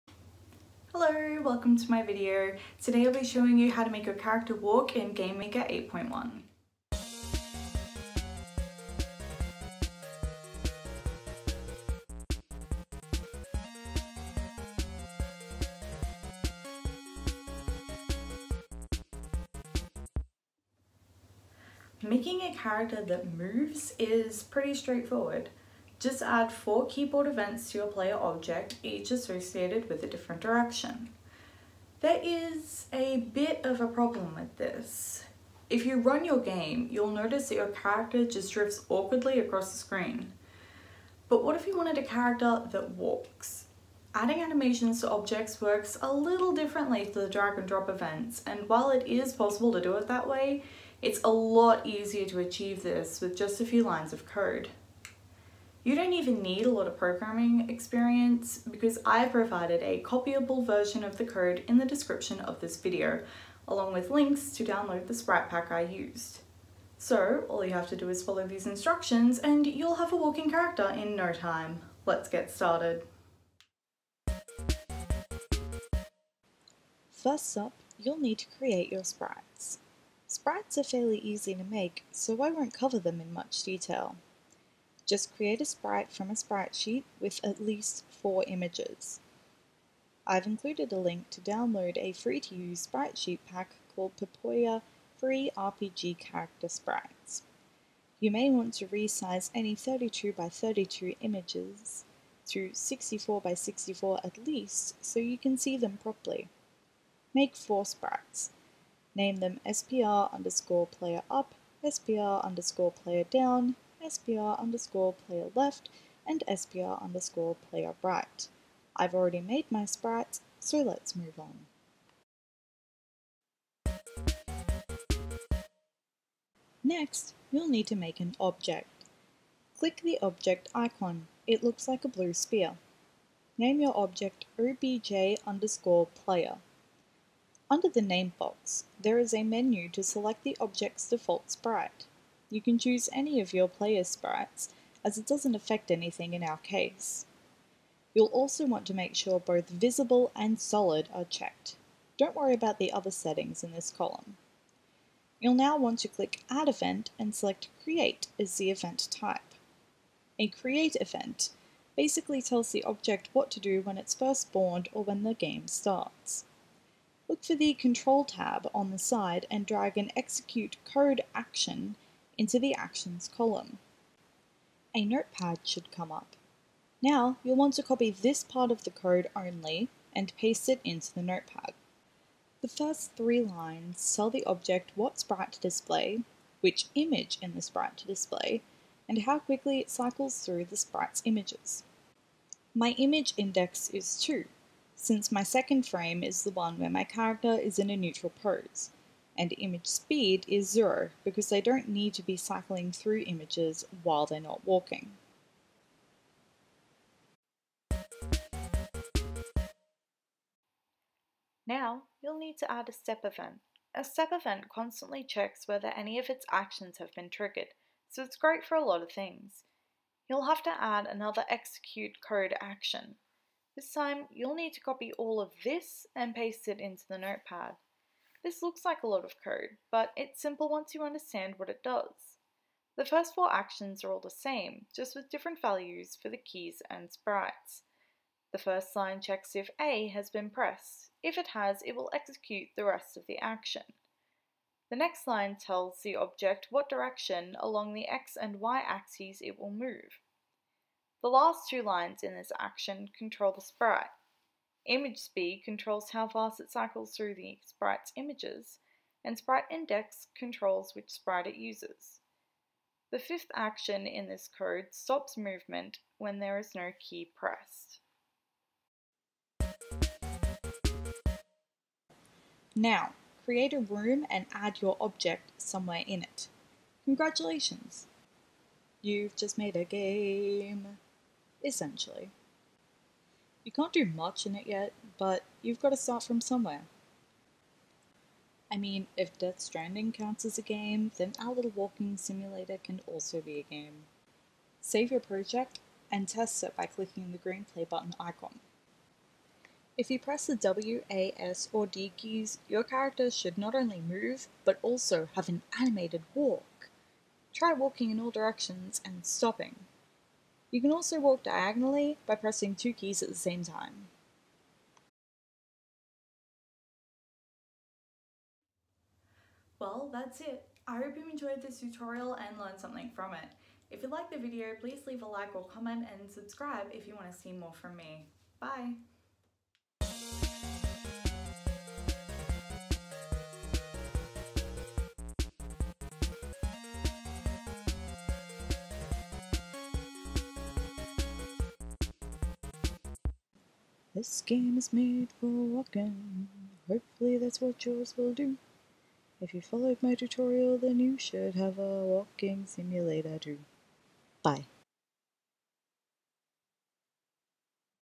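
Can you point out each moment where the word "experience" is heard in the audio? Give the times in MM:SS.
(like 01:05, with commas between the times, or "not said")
00:57.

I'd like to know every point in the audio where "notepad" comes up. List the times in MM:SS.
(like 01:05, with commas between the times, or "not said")
02:55, 03:01, 03:47.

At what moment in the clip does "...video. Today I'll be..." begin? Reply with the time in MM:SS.
00:02.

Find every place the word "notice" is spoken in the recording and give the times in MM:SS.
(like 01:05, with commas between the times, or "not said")
00:37.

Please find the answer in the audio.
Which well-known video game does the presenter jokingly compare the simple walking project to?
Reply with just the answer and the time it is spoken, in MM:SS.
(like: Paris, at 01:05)
Death Stranding, at 04:49.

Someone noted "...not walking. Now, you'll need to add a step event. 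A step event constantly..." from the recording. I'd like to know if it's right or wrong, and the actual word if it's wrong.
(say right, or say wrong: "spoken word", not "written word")
right.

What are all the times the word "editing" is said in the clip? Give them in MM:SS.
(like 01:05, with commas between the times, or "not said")
not said.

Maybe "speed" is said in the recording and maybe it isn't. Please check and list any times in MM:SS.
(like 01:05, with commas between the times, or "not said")
03:19, 04:15.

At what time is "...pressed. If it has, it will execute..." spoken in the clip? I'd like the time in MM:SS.
04:00.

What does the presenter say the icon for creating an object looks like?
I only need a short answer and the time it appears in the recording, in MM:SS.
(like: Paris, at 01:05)
A blue sphere, at 02:12.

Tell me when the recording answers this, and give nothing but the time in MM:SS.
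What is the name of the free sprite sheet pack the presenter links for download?
01:34.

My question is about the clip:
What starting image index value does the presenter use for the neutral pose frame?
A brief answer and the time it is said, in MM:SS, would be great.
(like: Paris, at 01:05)
2, at 03:14.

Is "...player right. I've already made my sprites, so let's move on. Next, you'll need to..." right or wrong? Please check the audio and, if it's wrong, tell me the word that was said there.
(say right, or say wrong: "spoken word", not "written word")
right.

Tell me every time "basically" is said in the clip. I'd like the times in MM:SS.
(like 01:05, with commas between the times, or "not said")
02:41.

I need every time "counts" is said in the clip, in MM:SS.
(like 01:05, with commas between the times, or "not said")
04:50.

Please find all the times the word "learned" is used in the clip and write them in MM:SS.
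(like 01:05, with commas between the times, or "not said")
05:22.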